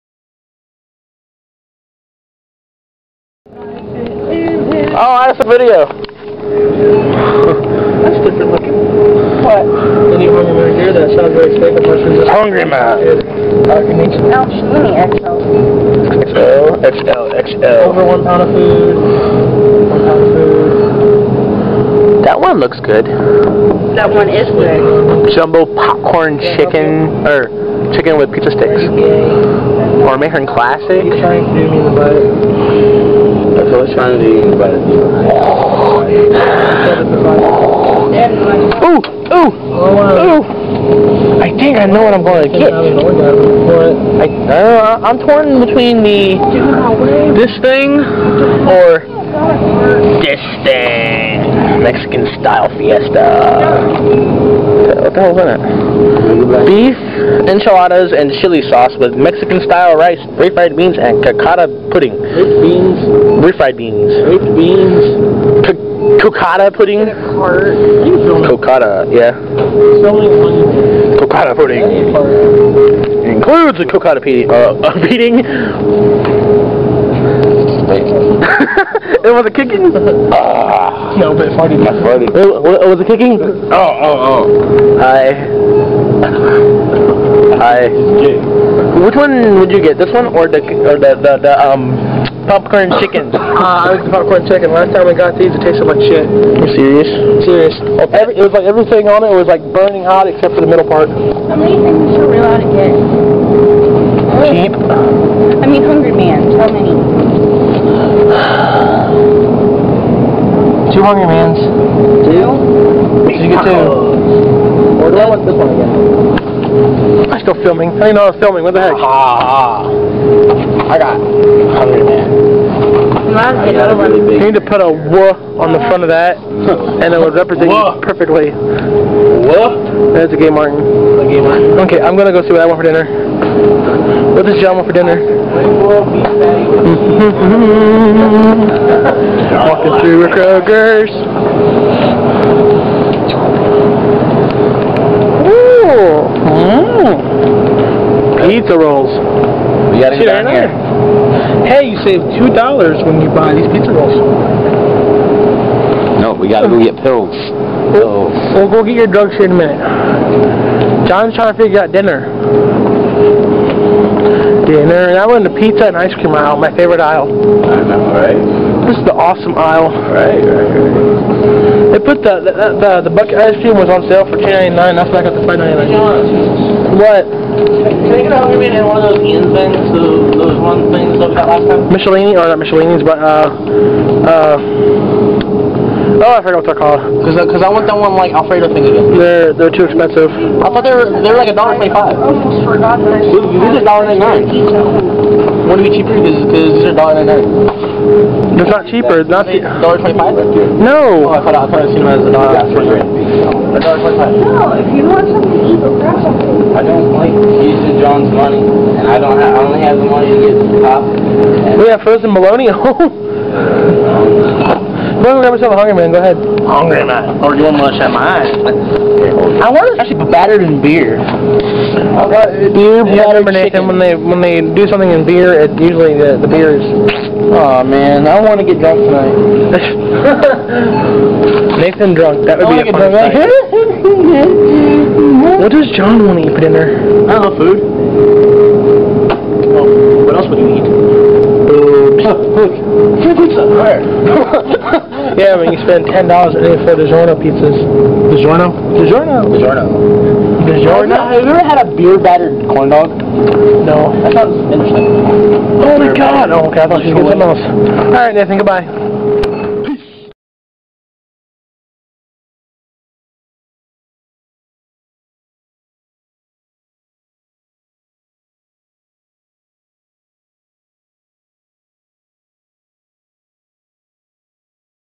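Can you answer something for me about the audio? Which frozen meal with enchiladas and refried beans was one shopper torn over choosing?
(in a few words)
Mexican style fiesta.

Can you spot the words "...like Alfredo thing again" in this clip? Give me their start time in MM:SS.
03:08.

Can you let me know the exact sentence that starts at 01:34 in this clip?
Last time we got these, it tasted like shit.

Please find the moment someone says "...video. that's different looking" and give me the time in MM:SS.
00:05.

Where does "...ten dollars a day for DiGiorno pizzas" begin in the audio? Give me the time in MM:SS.
04:06.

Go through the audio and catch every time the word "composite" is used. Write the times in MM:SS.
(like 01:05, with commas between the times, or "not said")
not said.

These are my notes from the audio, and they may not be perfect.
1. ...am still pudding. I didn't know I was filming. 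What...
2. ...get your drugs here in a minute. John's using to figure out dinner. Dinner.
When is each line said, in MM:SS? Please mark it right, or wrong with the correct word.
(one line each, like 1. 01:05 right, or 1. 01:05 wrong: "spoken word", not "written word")
1. 01:57 wrong: "filming", not "pudding"
2. 02:38 wrong: "trying", not "using".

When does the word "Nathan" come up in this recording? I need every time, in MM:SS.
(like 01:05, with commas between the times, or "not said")
03:51, 04:18.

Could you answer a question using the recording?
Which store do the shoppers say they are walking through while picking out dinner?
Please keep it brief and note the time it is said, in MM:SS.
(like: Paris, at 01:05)
Kroger's, at 02:20.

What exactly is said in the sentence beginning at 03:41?
Uh, beer battered And When they when they do something in beer, it usually the, the beer is.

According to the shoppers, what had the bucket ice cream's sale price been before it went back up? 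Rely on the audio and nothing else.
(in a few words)
$2.99.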